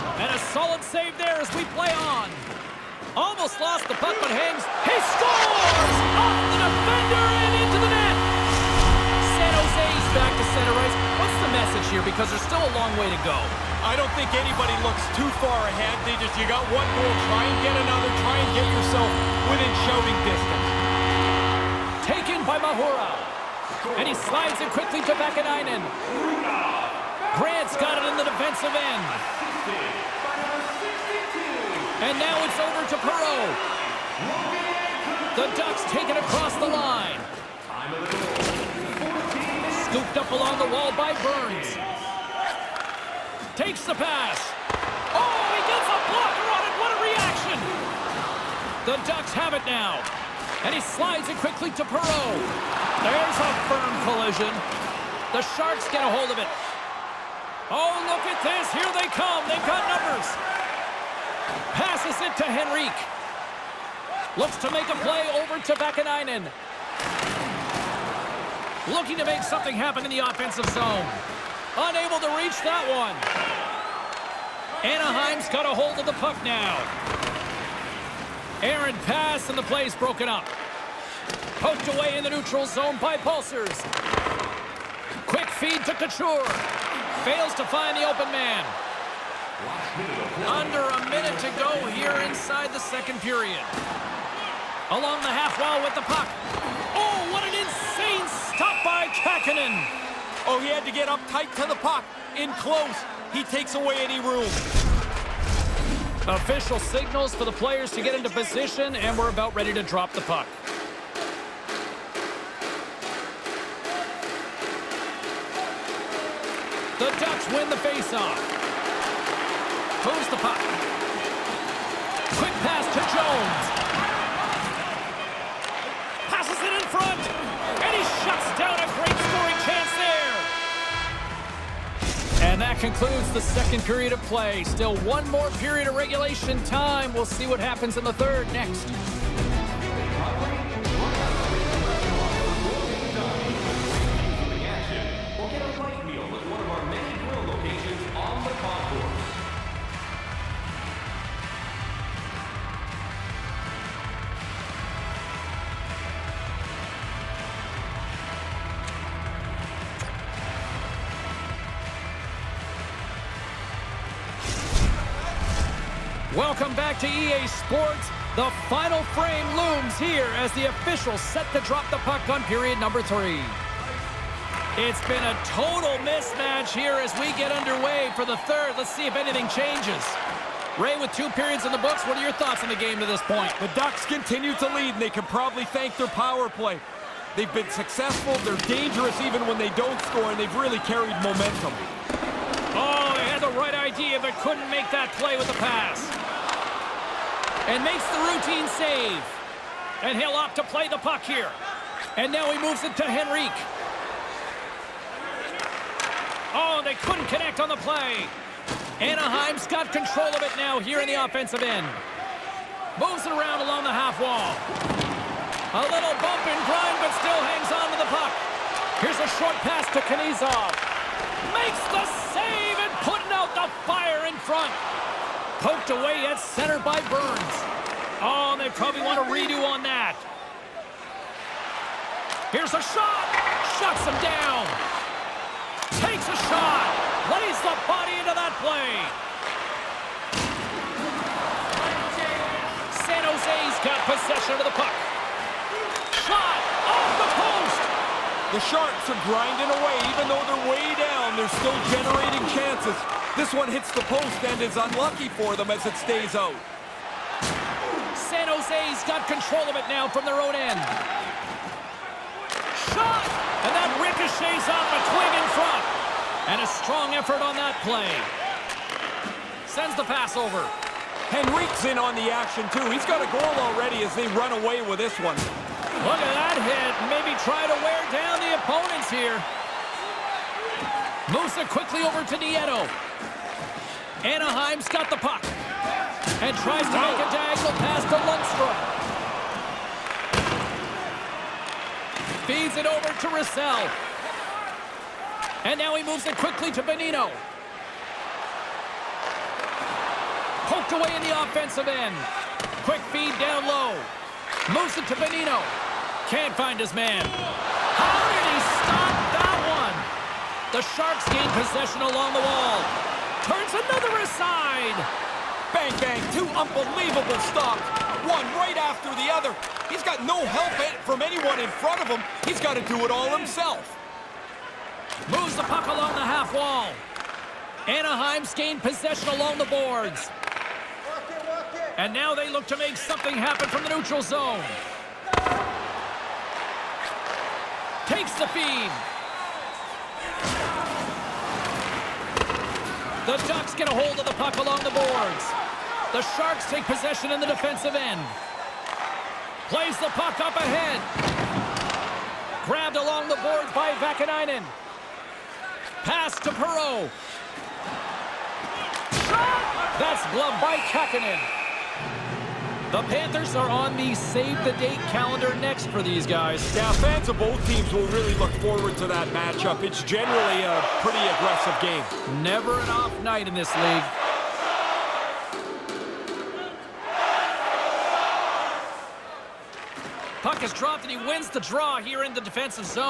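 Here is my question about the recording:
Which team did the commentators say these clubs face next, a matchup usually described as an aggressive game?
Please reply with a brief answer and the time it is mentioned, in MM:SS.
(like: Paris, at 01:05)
Panthers, at 06:03.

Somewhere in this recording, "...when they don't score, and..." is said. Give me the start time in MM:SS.
03:09.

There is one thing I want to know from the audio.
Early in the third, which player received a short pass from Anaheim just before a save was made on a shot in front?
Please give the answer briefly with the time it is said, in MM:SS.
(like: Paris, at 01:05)
Knyzhov, at 03:40.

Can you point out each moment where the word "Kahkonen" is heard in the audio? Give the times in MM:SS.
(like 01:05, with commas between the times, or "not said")
01:39, 06:00.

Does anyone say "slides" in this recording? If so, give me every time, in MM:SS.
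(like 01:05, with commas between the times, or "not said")
00:24, 00:50.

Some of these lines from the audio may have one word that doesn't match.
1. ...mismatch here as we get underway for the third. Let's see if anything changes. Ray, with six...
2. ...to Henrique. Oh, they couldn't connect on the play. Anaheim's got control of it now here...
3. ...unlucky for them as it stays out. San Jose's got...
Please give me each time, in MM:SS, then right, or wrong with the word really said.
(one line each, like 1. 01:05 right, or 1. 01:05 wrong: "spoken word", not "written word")
1. 02:56 wrong: "two", not "six"
2. 03:22 right
3. 04:14 right.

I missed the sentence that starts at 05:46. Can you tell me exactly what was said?
The Sharks take possession in the defensive end.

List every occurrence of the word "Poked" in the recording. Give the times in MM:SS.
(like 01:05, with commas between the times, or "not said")
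01:21, 03:45, 05:00.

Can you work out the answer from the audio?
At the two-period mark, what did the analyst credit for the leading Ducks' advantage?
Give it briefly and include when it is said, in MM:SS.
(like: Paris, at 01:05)
Their power play, at 03:05.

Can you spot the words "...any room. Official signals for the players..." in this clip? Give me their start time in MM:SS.
01:43.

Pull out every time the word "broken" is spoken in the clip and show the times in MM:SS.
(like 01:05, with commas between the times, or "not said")
01:19.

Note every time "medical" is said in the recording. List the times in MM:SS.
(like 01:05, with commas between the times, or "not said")
not said.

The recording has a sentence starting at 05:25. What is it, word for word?
Moves the puck along the half wall.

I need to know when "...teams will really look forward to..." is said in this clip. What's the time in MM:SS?
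06:07.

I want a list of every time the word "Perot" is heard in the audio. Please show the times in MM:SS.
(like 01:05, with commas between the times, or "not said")
00:33, 00:51, 05:56.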